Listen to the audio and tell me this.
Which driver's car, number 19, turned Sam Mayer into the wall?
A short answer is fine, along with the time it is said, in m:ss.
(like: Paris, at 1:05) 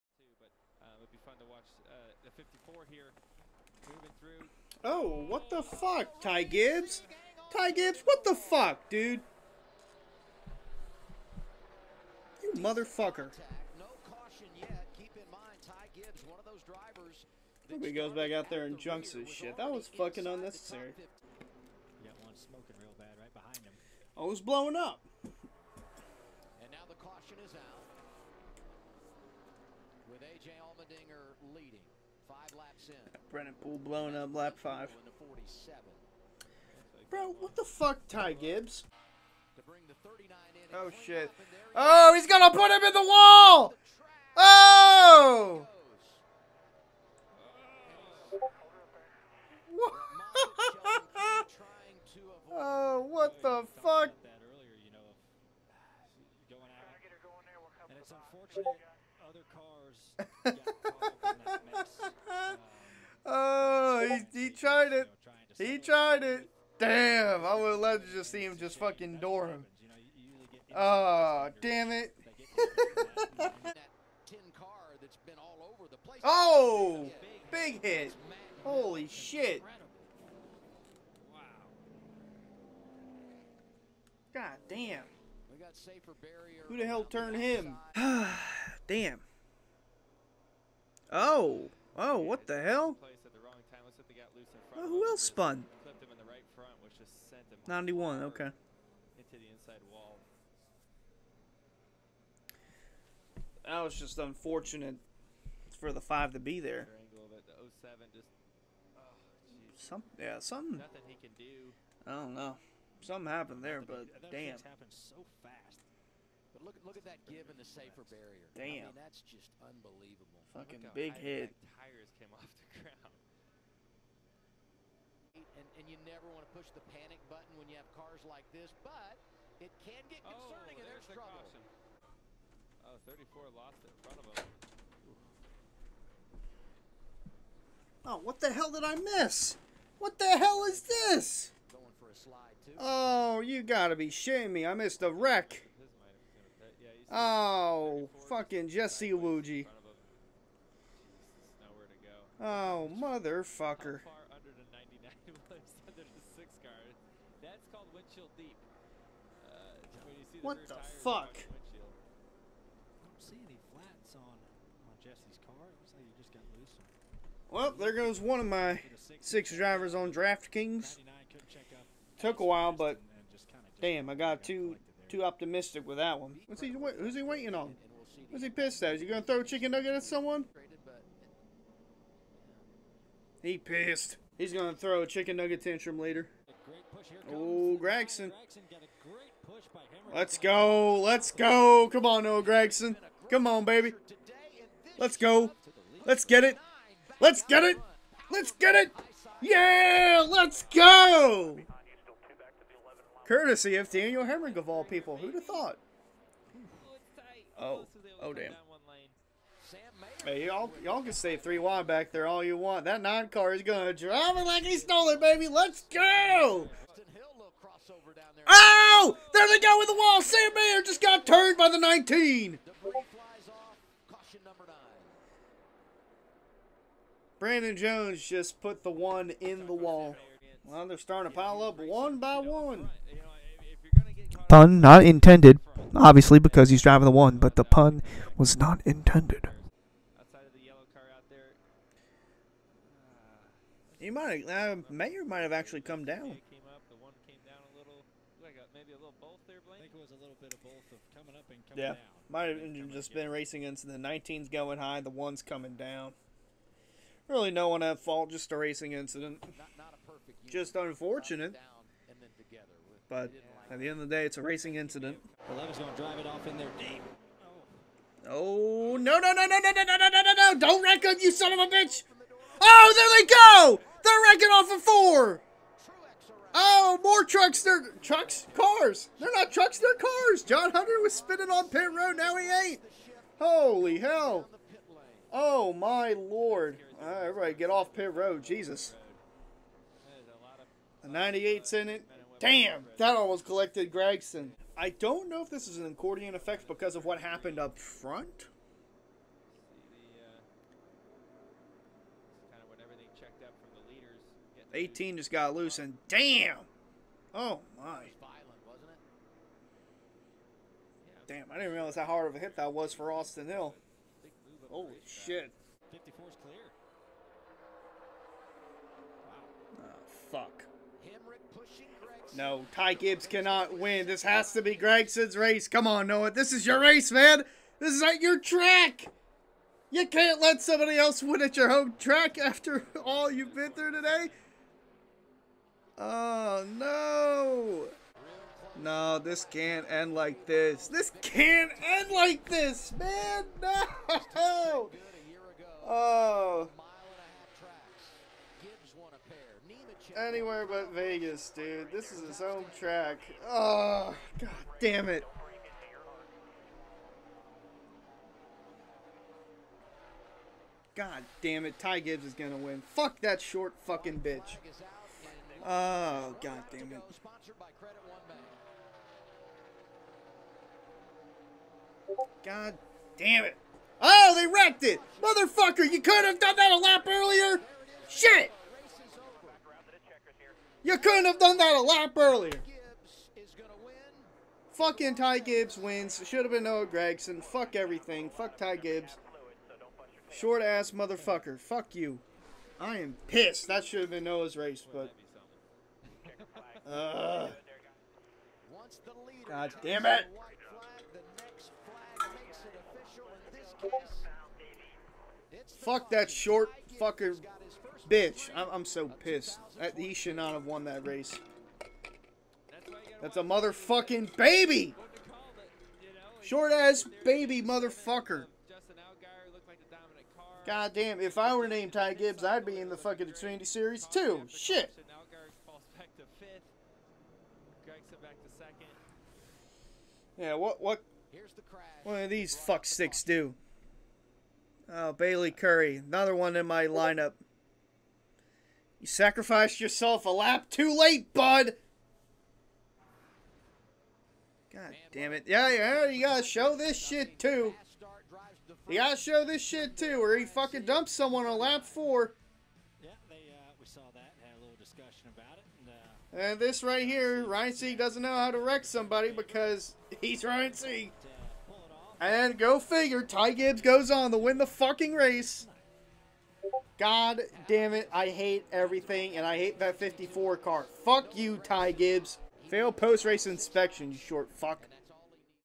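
Brandon Jones, at 3:47.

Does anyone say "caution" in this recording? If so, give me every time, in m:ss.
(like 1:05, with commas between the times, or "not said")
0:26, 2:11.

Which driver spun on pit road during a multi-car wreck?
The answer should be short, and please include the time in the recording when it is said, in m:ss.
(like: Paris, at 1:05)
John Hunter, at 4:40.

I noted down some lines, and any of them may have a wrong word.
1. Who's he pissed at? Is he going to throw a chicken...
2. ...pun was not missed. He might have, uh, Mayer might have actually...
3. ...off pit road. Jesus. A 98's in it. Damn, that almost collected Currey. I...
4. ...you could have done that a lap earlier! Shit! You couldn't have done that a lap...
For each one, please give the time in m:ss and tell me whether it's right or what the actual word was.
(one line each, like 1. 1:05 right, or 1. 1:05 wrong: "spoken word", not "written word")
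1. 2:58 right
2. 3:57 wrong: "intended", not "missed"
3. 4:47 wrong: "Gragson", not "Currey"
4. 6:15 right.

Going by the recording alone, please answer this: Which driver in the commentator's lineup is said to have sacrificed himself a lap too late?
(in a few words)
Bayley Currey.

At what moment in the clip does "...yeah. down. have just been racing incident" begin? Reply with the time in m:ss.
4:11.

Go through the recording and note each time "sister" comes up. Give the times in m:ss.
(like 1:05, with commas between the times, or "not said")
not said.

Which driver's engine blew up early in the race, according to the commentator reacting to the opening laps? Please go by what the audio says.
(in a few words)
Brennan Poole.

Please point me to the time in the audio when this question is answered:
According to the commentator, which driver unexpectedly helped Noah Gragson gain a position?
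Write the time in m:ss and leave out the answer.
3:23.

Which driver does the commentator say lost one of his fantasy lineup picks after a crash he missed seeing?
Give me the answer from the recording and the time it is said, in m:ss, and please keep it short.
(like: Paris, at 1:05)
Jesse Iwuji, at 2:28.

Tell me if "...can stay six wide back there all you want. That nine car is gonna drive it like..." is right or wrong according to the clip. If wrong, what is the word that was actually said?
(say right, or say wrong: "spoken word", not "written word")
wrong: "three", not "six".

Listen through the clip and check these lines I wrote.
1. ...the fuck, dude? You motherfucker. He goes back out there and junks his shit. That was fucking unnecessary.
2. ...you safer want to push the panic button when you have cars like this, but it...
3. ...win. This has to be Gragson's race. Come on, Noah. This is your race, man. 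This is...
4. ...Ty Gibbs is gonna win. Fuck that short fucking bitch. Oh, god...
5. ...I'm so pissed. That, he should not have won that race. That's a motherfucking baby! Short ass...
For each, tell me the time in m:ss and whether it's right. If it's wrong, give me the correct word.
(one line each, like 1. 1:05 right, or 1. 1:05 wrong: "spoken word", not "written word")
1. 0:08 right
2. 2:05 wrong: "never", not "safer"
3. 5:23 right
4. 6:01 right
5. 6:48 right.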